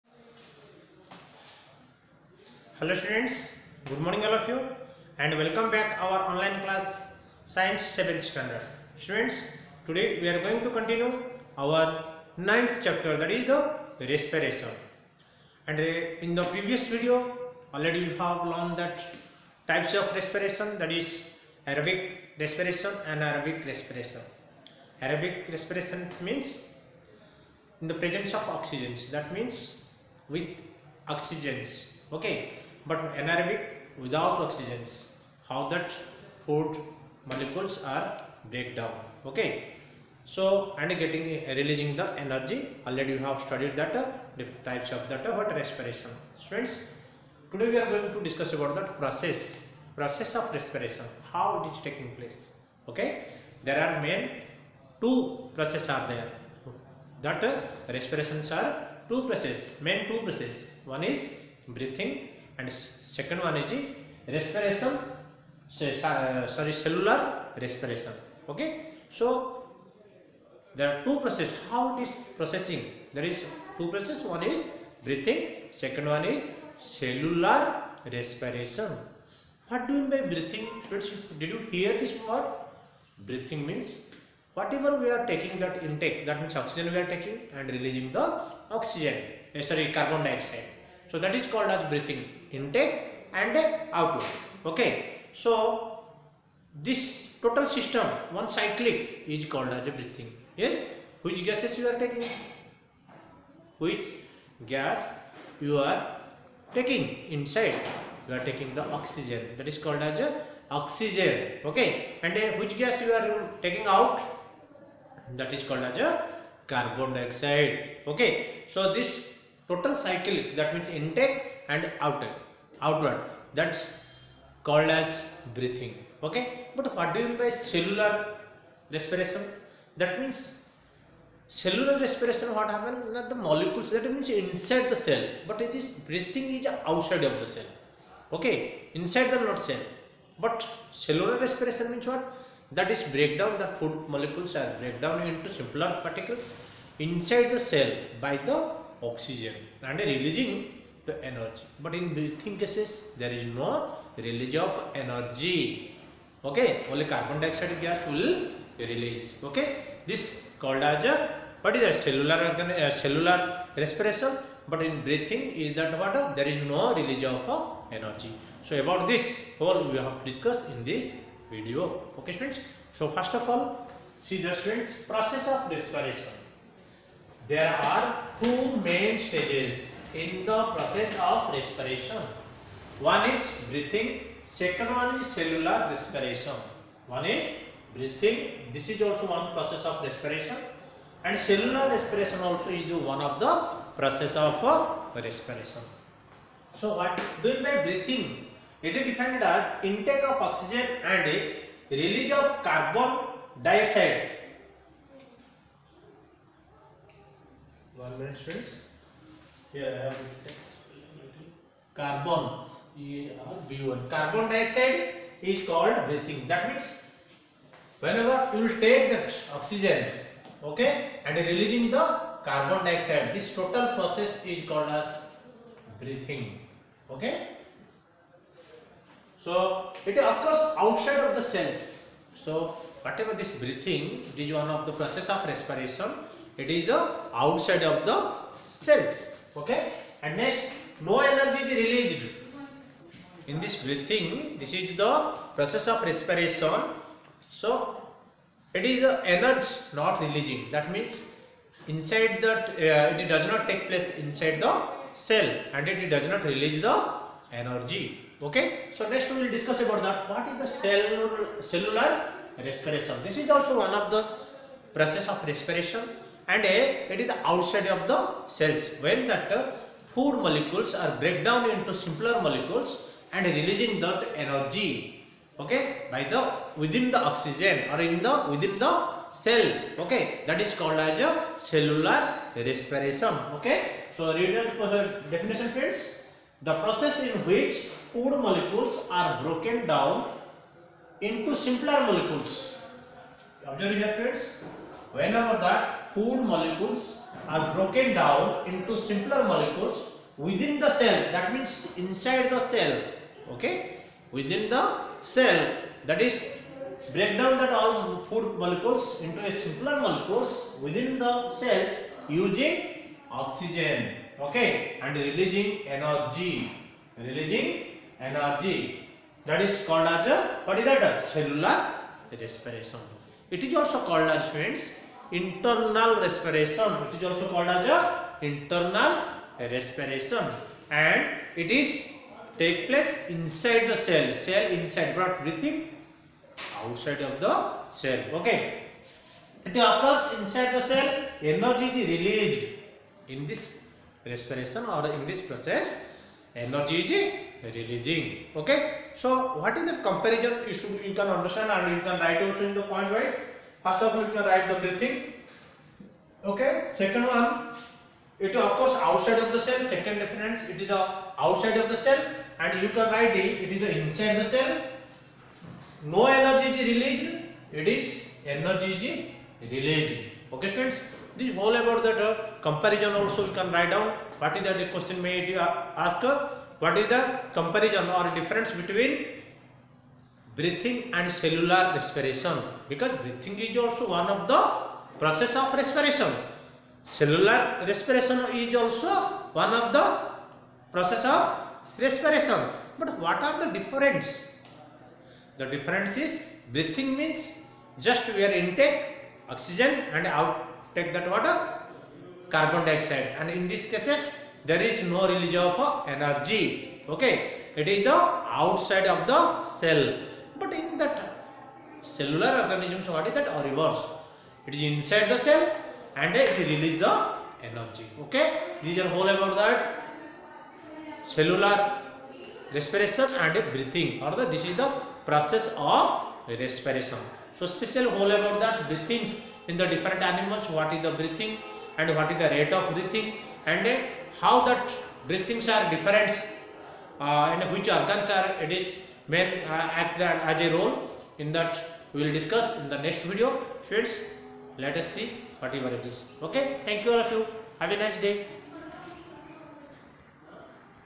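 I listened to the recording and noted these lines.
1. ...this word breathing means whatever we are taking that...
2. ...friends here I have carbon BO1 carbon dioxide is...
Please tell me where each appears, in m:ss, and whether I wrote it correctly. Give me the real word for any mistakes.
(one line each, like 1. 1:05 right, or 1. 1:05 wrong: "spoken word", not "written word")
1. 1:22 right
2. 3:28 right.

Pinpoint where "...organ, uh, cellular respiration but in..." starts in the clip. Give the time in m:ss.
2:42.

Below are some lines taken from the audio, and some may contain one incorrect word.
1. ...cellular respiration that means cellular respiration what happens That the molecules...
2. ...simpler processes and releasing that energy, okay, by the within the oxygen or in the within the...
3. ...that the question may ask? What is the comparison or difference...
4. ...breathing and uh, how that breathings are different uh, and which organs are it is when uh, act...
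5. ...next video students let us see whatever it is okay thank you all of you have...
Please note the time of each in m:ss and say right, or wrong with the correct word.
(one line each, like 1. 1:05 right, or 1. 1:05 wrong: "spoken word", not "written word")
1. 2:07 right
2. 4:31 wrong: "molecules", not "processes"
3. 6:14 right
4. 7:12 right
5. 7:23 right.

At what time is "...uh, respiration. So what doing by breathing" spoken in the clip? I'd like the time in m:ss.
3:14.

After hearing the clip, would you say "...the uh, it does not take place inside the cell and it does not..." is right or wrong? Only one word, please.
right.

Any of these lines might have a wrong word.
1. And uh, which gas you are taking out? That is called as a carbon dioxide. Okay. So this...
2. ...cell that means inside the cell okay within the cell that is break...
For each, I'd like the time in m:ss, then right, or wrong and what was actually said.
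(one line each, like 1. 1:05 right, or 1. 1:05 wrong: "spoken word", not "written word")
1. 1:52 right
2. 5:01 right.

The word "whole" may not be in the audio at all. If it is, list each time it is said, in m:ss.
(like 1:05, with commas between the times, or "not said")
6:11, 6:59, 7:08.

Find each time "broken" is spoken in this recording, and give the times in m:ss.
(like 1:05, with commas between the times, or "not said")
4:49, 4:57.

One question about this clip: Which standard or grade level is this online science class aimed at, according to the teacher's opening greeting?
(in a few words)
7th standard.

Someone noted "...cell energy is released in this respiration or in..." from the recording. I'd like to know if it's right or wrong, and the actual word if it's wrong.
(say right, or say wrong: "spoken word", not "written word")
right.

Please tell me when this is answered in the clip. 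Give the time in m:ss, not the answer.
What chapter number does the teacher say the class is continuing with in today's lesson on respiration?
0:12.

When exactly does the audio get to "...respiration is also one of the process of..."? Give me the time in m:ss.
6:27.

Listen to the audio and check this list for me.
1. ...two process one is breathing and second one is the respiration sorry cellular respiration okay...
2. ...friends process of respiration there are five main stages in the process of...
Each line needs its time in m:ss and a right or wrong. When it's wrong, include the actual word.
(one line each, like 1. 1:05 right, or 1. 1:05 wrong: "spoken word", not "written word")
1. 1:00 right
2. 2:54 wrong: "two", not "five".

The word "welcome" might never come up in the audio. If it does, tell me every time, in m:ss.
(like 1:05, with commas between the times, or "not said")
0:05.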